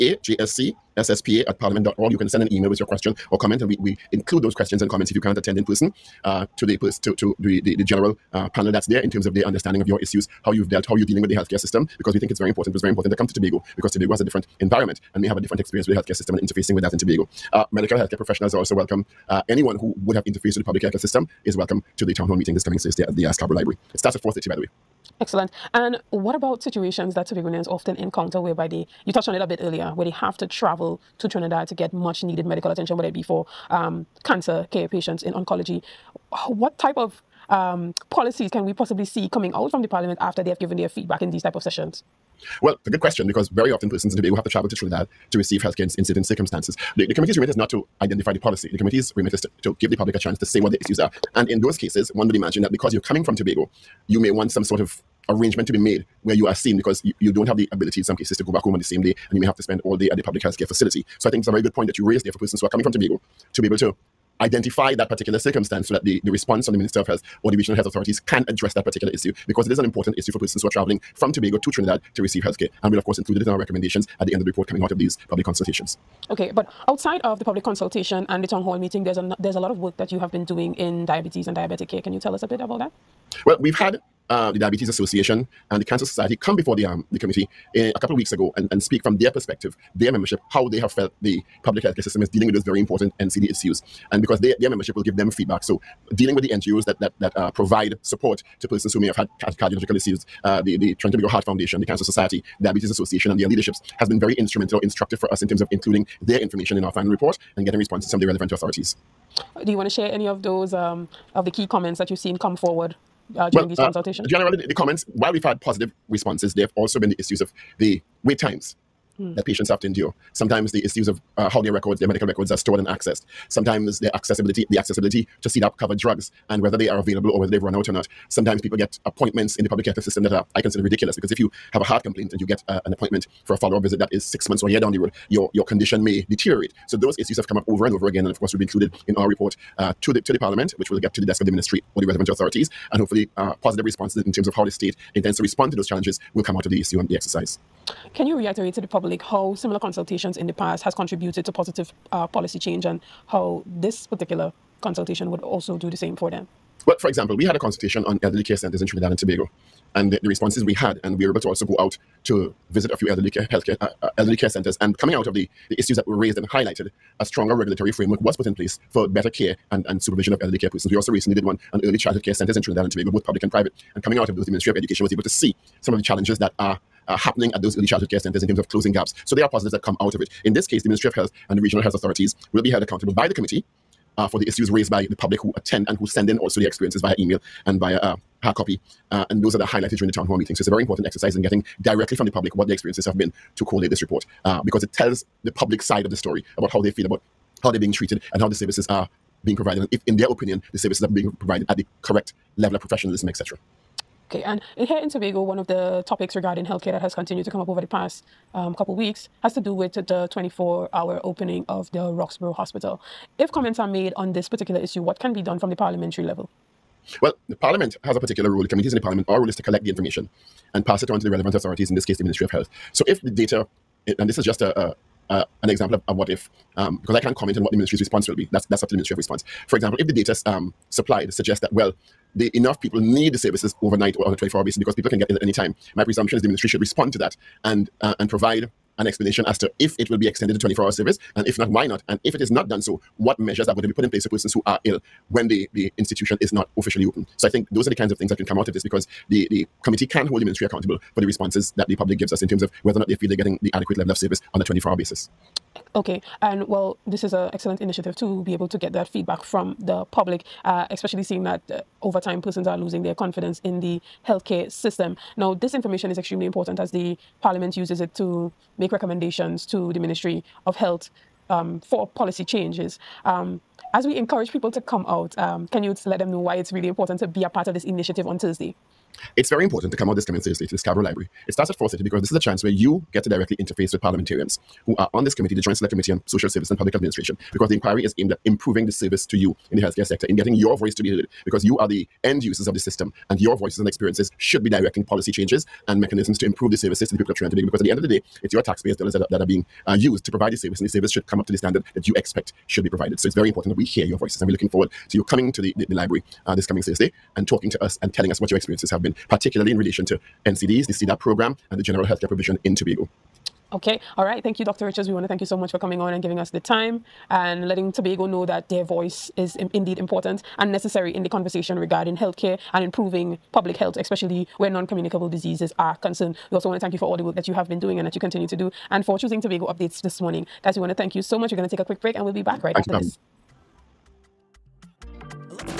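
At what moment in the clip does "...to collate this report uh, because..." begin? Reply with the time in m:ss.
3:13.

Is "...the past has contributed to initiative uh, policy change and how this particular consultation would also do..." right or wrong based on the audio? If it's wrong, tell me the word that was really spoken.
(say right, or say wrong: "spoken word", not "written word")
wrong: "positive", not "initiative".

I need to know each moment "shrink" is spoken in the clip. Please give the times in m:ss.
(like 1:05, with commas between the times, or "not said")
not said.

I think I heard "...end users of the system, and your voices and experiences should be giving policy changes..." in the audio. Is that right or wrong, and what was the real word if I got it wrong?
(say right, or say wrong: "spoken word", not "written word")
wrong: "directing", not "giving".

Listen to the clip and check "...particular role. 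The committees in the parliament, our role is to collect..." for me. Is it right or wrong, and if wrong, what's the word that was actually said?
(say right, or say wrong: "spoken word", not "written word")
right.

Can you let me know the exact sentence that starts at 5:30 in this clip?
Guys, we want to thank you so much.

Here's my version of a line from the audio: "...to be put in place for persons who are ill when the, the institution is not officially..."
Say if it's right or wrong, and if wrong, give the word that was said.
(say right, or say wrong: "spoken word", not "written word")
right.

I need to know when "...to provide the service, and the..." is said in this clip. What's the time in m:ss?
5:00.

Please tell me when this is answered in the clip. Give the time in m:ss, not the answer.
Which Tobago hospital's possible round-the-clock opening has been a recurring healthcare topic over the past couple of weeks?
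3:32.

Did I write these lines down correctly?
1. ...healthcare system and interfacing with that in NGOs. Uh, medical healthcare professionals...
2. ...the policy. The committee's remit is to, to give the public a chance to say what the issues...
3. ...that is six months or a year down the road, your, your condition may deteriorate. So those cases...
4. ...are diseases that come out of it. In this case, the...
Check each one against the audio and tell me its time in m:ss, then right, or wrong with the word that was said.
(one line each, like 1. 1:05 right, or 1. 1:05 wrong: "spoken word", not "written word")
1. 0:15 wrong: "Tobago", not "NGOs"
2. 0:48 right
3. 2:13 wrong: "issues", not "cases"
4. 2:59 wrong: "positives", not "diseases".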